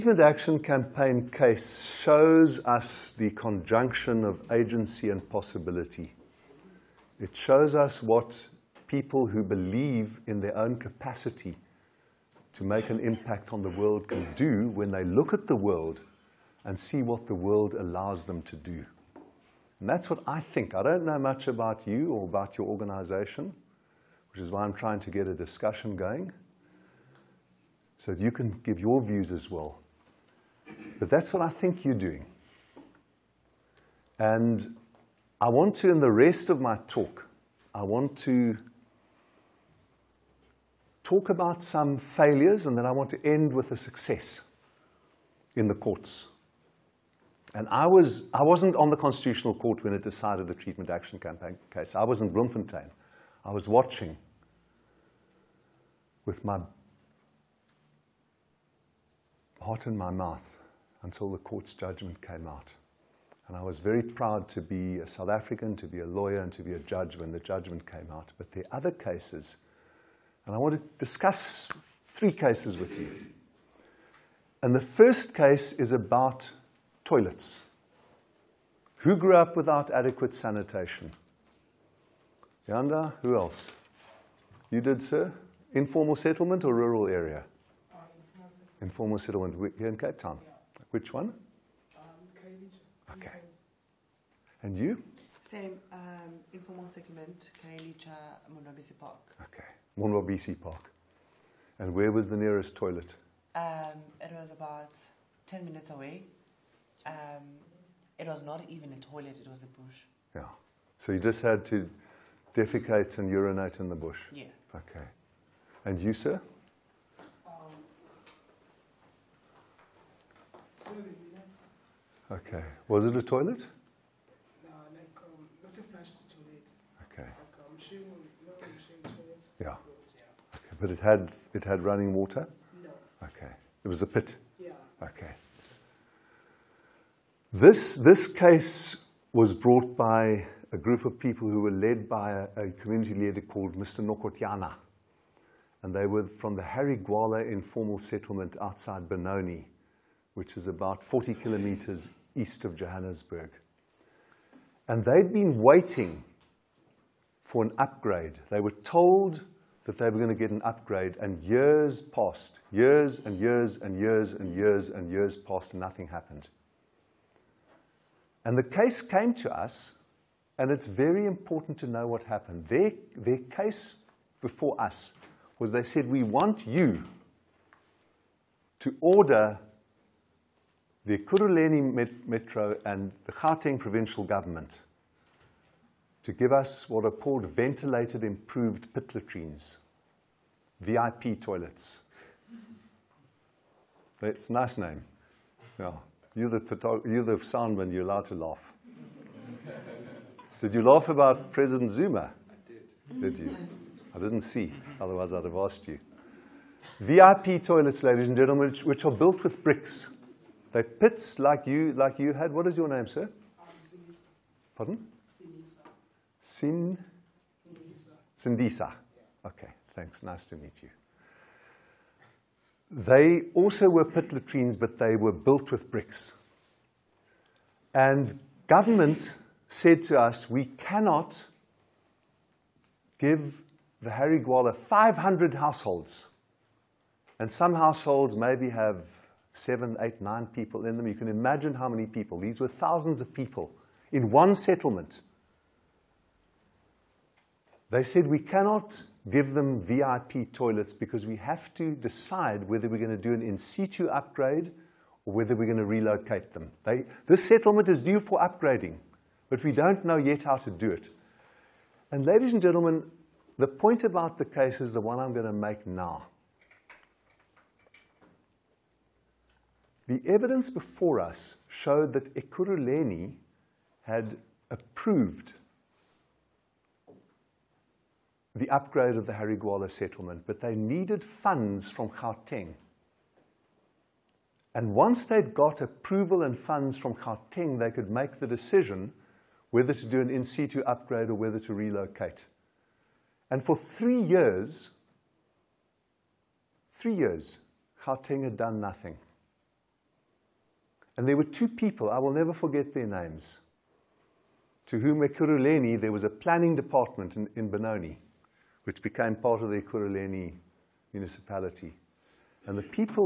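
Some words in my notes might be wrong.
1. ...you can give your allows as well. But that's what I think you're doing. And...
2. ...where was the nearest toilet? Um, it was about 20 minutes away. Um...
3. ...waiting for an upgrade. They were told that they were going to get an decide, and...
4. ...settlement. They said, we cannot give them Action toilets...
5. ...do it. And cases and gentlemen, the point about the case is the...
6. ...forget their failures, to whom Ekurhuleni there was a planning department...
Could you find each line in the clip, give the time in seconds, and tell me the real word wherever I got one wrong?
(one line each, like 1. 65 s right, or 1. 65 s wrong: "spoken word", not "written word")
1. 28 s wrong: "views", not "allows"
2. 101 s wrong: "10", not "20"
3. 155 s wrong: "upgrade", not "decide"
4. 244 s wrong: "VIP", not "Action"
5. 260 s wrong: "ladies", not "cases"
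6. 302 s wrong: "names", not "failures".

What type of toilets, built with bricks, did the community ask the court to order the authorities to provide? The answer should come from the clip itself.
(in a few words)
Ventilated improved pit latrines.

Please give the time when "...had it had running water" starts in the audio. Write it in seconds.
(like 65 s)
131 s.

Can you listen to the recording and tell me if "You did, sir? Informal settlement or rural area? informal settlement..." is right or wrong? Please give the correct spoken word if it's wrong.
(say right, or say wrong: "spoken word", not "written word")
right.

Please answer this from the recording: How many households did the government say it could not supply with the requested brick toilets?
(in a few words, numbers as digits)
500.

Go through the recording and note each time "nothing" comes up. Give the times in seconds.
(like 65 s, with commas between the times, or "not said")
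165 s, 298 s.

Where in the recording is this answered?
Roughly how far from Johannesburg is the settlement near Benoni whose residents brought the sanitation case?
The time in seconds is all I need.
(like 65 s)
151 s.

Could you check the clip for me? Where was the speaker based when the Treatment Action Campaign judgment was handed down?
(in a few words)
Bloemfontein.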